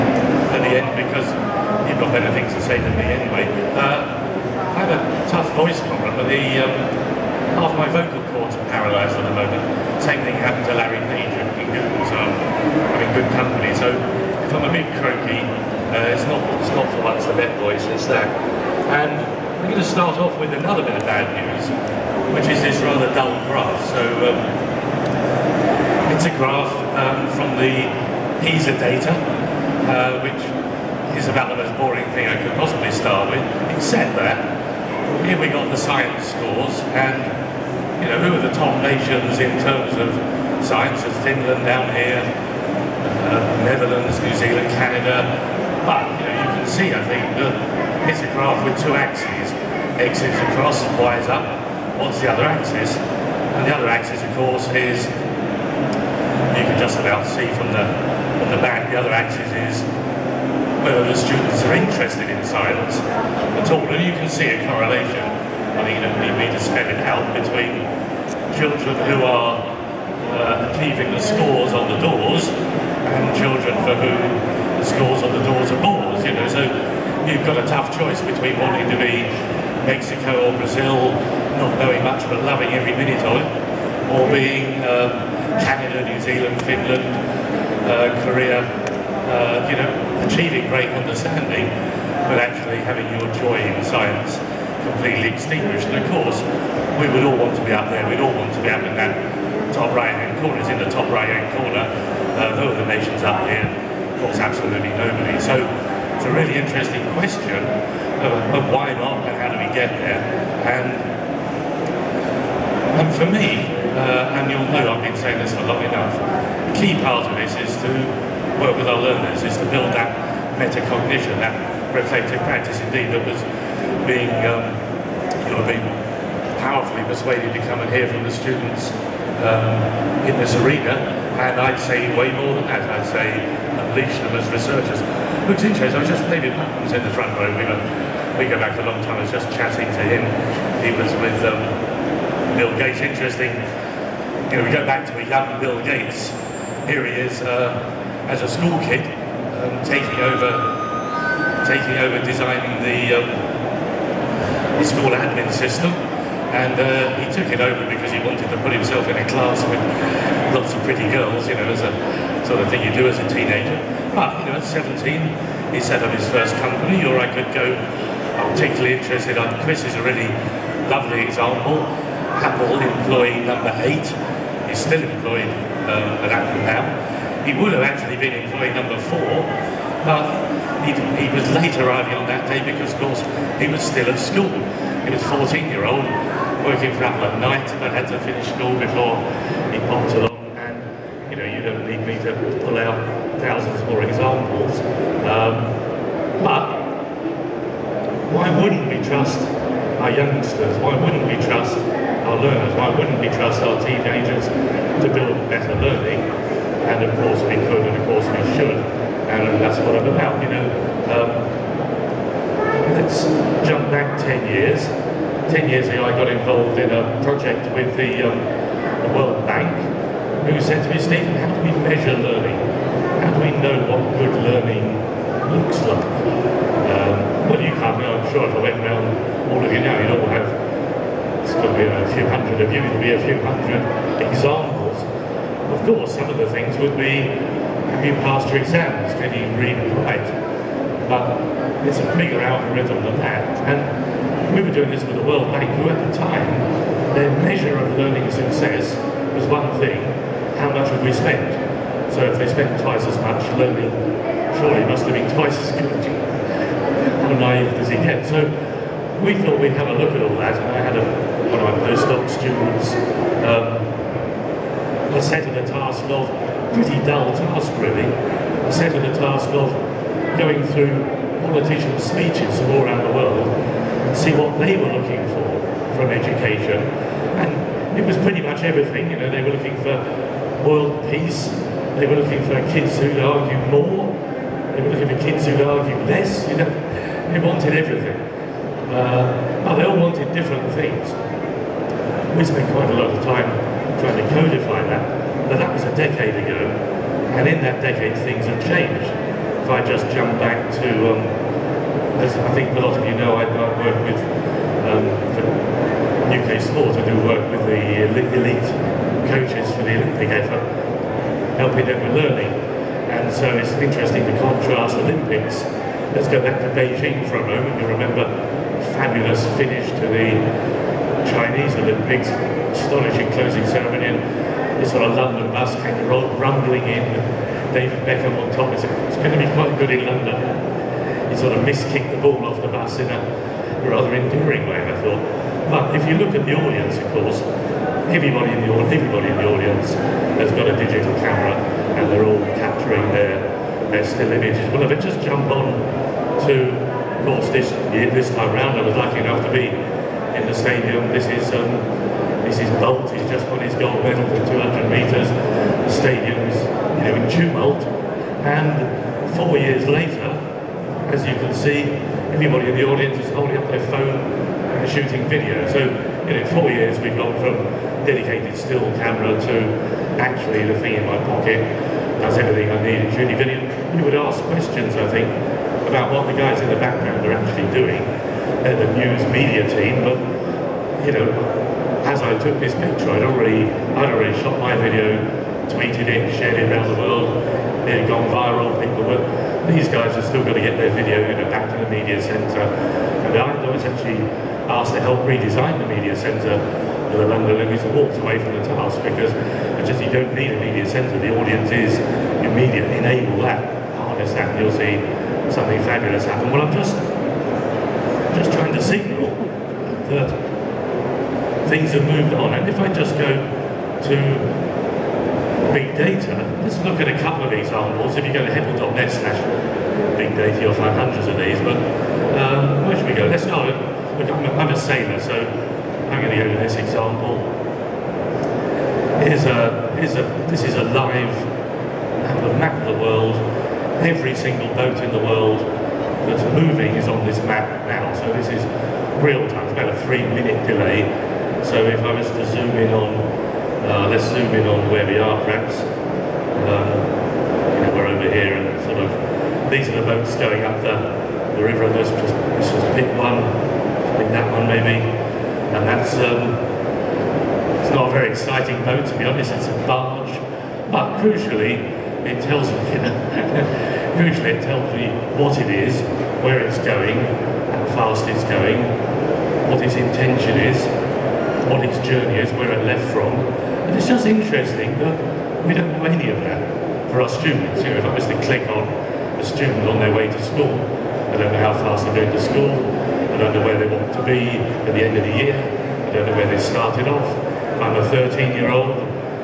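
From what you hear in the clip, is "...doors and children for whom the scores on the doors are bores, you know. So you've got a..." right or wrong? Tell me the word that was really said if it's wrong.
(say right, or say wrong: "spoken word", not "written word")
right.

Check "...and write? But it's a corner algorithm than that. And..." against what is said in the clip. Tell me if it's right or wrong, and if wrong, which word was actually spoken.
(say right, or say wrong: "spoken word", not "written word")
wrong: "bigger", not "corner".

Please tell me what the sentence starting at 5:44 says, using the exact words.
Well, if I just jump on to, of course, this this time round, I was lucky enough to be in the stadium.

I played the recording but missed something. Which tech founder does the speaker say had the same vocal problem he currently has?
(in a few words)
Larry Page.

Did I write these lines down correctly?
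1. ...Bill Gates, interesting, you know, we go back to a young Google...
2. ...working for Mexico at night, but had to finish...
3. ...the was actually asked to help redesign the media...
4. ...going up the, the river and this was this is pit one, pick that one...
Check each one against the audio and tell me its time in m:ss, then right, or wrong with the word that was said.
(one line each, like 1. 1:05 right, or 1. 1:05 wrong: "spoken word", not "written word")
1. 2:22 wrong: "Bill", not "Google"
2. 3:06 wrong: "Apple", not "Mexico"
3. 6:33 right
4. 7:30 right.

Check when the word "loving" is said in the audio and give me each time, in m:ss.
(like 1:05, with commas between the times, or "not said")
1:22.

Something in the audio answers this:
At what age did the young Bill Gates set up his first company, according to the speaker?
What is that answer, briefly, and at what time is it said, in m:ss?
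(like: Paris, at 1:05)
17, at 2:44.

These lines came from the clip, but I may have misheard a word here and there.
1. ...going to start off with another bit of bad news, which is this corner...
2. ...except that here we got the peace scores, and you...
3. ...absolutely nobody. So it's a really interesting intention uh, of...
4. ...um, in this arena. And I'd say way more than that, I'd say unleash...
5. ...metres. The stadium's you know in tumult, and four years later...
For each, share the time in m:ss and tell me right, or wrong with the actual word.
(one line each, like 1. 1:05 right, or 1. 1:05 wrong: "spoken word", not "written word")
1. 0:19 wrong: "rather", not "corner"
2. 0:33 wrong: "science", not "peace"
3. 1:44 wrong: "question", not "intention"
4. 2:09 right
5. 5:54 right.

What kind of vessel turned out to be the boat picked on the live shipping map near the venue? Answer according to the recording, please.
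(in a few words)
a barge.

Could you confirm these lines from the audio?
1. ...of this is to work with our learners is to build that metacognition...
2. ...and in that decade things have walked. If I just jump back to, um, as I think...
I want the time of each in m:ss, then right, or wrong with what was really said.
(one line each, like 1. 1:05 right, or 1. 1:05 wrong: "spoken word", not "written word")
1. 1:57 right
2. 4:57 wrong: "changed", not "walked".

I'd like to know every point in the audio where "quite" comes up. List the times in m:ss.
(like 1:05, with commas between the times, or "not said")
4:52, 5:29.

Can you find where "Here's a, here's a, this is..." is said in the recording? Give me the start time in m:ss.
7:09.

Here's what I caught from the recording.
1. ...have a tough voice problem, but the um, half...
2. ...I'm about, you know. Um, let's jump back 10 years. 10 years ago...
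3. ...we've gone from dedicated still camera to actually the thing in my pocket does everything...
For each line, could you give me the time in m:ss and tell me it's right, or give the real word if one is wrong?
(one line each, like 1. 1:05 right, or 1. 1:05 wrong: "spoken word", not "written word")
1. 0:04 right
2. 3:29 right
3. 6:06 right.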